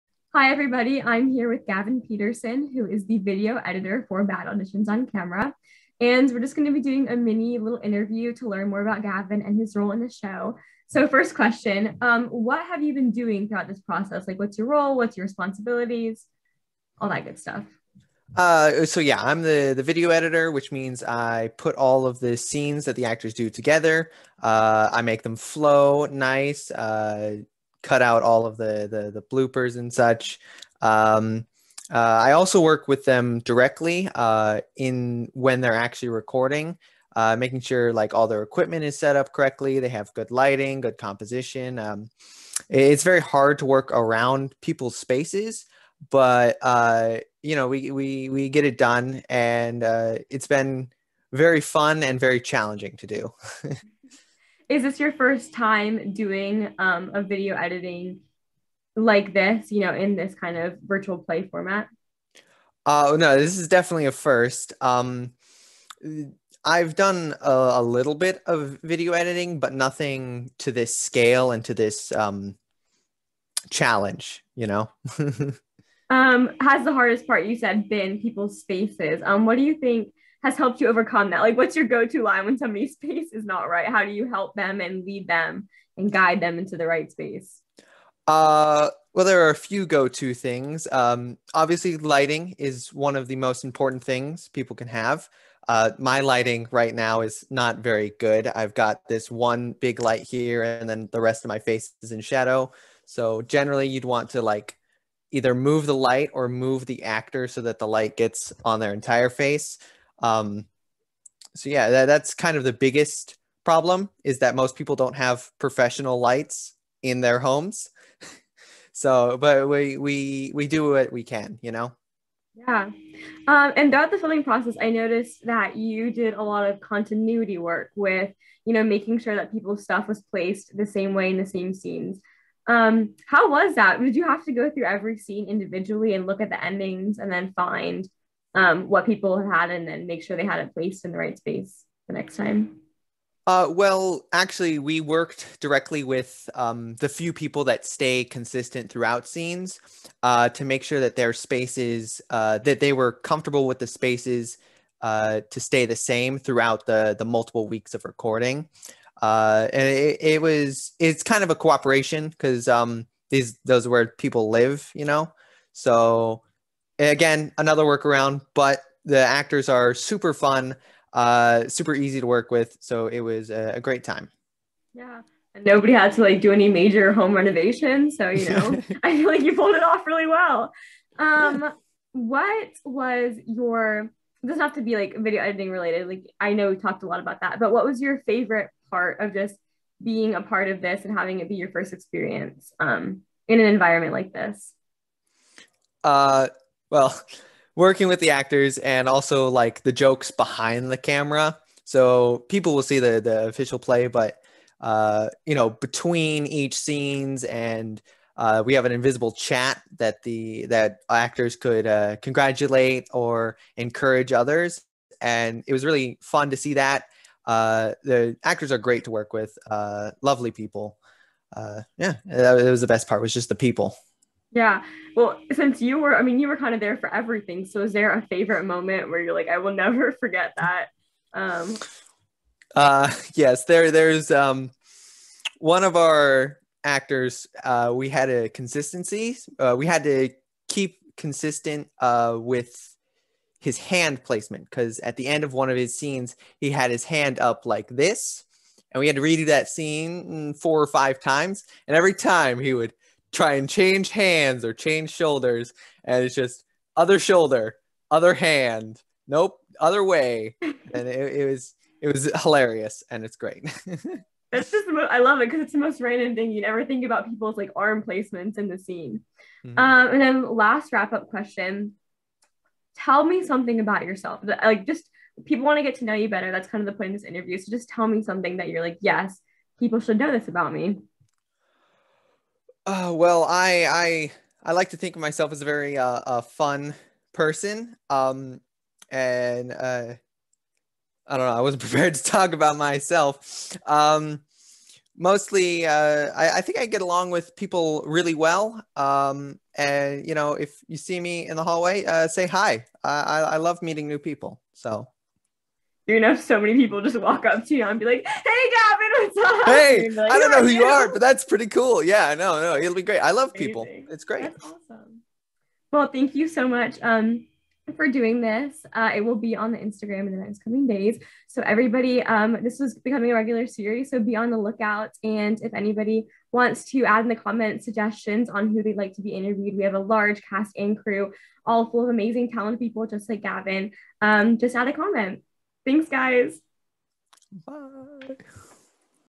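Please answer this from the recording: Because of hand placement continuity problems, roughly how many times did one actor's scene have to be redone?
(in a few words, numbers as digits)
4 or 5.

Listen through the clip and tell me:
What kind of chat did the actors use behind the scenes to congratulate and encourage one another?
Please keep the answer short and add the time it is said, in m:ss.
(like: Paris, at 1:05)
invisible chat, at 3:28.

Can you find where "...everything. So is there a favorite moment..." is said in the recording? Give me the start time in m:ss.
3:47.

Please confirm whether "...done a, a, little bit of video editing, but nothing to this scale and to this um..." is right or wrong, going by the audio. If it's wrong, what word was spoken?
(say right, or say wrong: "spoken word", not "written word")
right.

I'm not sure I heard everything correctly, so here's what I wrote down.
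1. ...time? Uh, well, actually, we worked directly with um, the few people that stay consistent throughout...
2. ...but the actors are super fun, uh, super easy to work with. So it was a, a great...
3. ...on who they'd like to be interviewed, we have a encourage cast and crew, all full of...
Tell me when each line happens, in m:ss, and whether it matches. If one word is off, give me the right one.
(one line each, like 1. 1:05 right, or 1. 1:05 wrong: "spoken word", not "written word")
1. 2:22 right
2. 2:48 right
3. 5:28 wrong: "large", not "encourage".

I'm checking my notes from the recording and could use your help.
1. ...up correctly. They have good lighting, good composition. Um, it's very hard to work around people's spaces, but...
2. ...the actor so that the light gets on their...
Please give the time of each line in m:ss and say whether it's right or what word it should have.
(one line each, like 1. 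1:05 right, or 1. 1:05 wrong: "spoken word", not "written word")
1. 0:39 right
2. 1:46 right.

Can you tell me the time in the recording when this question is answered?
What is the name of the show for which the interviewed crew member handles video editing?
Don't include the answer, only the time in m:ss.
0:04.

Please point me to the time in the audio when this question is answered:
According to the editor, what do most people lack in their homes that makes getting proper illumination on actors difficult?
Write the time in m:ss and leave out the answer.
1:55.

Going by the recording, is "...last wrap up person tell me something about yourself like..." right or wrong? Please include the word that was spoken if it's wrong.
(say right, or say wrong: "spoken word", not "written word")
wrong: "question", not "person".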